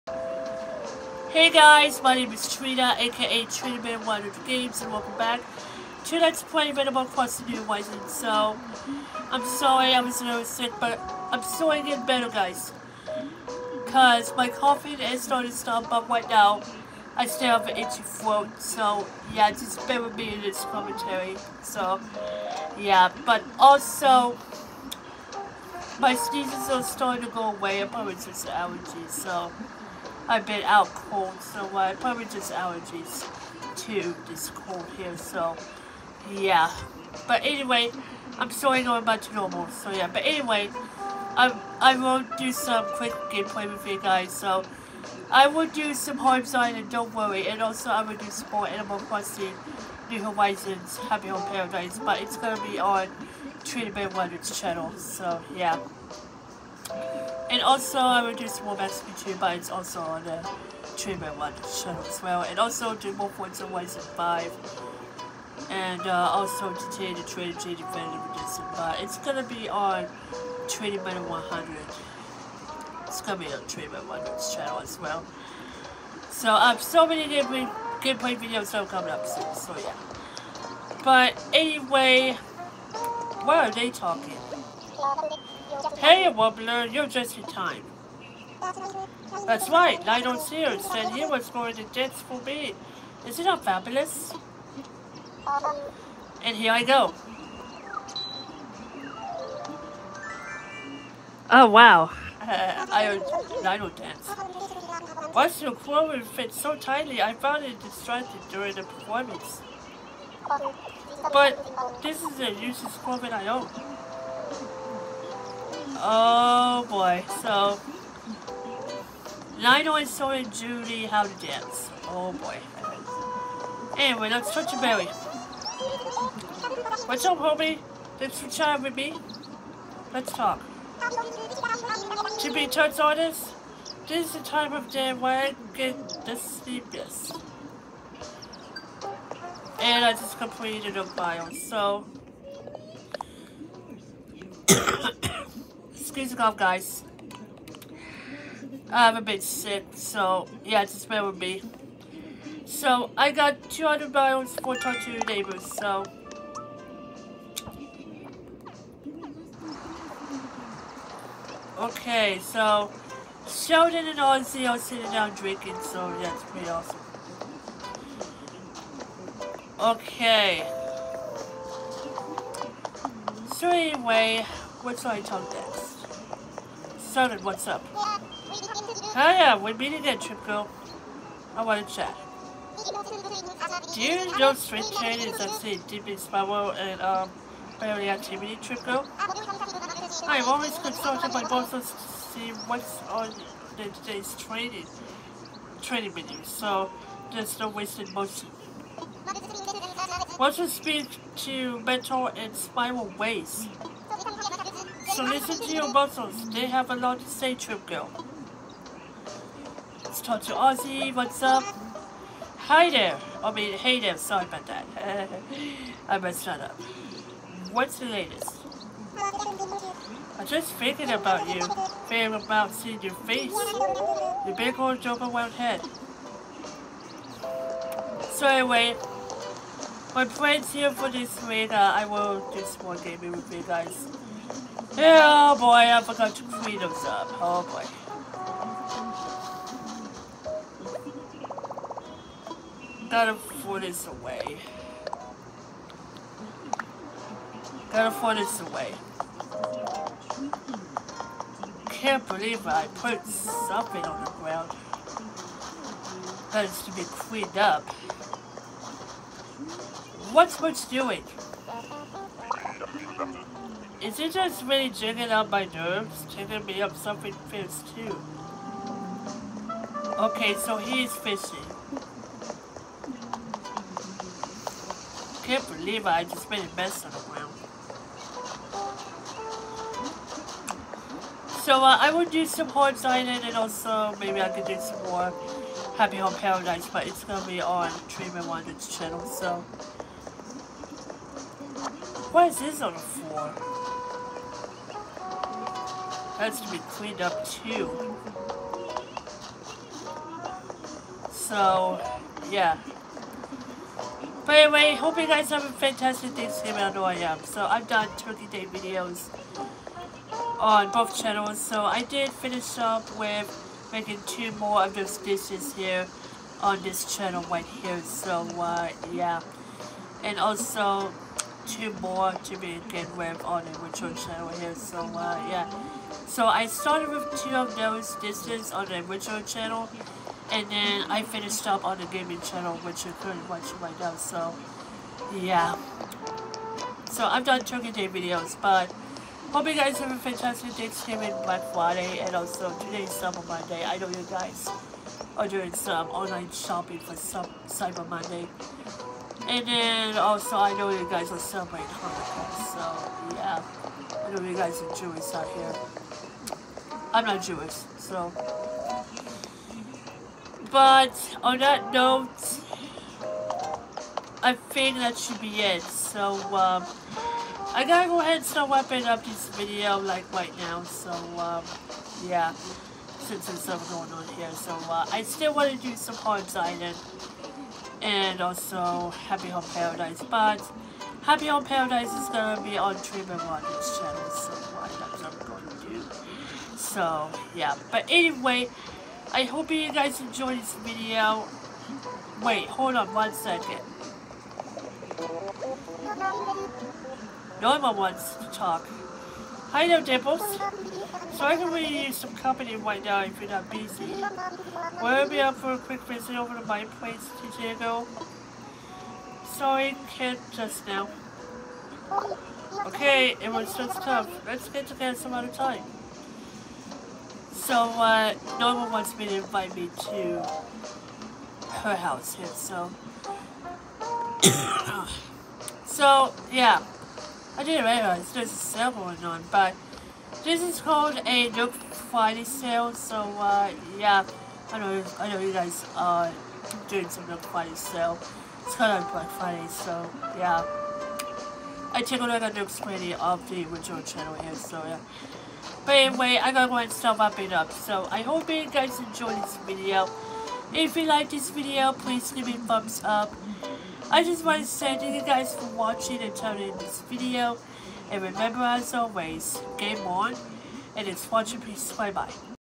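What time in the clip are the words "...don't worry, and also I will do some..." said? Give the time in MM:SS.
00:46.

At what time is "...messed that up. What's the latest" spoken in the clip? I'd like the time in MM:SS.
03:36.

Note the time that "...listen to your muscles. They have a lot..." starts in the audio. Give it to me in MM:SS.
03:25.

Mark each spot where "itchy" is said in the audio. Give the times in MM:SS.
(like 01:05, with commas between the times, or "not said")
00:17.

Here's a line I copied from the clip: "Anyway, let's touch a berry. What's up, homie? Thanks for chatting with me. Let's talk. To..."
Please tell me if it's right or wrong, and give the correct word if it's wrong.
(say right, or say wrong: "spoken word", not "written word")
right.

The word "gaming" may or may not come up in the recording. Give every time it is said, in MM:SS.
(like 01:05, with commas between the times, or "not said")
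03:52, 05:32.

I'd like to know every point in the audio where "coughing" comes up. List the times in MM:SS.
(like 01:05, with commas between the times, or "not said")
00:14.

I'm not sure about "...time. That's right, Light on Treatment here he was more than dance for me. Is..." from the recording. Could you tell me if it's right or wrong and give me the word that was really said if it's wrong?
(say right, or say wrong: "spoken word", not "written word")
wrong: "Sears", not "Treatment".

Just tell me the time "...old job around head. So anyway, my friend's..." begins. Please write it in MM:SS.
03:44.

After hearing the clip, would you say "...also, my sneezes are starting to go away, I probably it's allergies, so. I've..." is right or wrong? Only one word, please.
right.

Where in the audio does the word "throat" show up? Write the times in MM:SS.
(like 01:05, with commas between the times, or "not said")
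00:18.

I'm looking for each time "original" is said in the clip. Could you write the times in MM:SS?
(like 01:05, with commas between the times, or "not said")
05:29, 07:23.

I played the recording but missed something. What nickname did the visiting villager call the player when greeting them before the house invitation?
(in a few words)
Dimples.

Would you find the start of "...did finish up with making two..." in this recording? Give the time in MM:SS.
05:12.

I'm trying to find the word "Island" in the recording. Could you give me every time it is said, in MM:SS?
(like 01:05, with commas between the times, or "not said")
04:43, 06:16.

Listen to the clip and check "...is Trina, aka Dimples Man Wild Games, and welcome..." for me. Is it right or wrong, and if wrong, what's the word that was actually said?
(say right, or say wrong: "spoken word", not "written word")
wrong: "Trina", not "Dimples".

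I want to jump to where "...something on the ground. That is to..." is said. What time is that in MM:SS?
04:13.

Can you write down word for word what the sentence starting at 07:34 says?
I just want to say thank you guys for watching and turning this video.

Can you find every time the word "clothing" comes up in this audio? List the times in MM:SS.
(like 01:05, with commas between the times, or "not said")
01:45, 01:52.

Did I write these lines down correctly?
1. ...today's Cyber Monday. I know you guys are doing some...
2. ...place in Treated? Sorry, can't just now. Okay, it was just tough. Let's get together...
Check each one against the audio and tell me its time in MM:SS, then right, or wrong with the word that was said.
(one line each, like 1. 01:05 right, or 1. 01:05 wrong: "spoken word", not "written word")
1. 05:42 right
2. 06:46 wrong: "Diego", not "Treated".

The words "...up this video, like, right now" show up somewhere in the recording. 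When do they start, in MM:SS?
06:09.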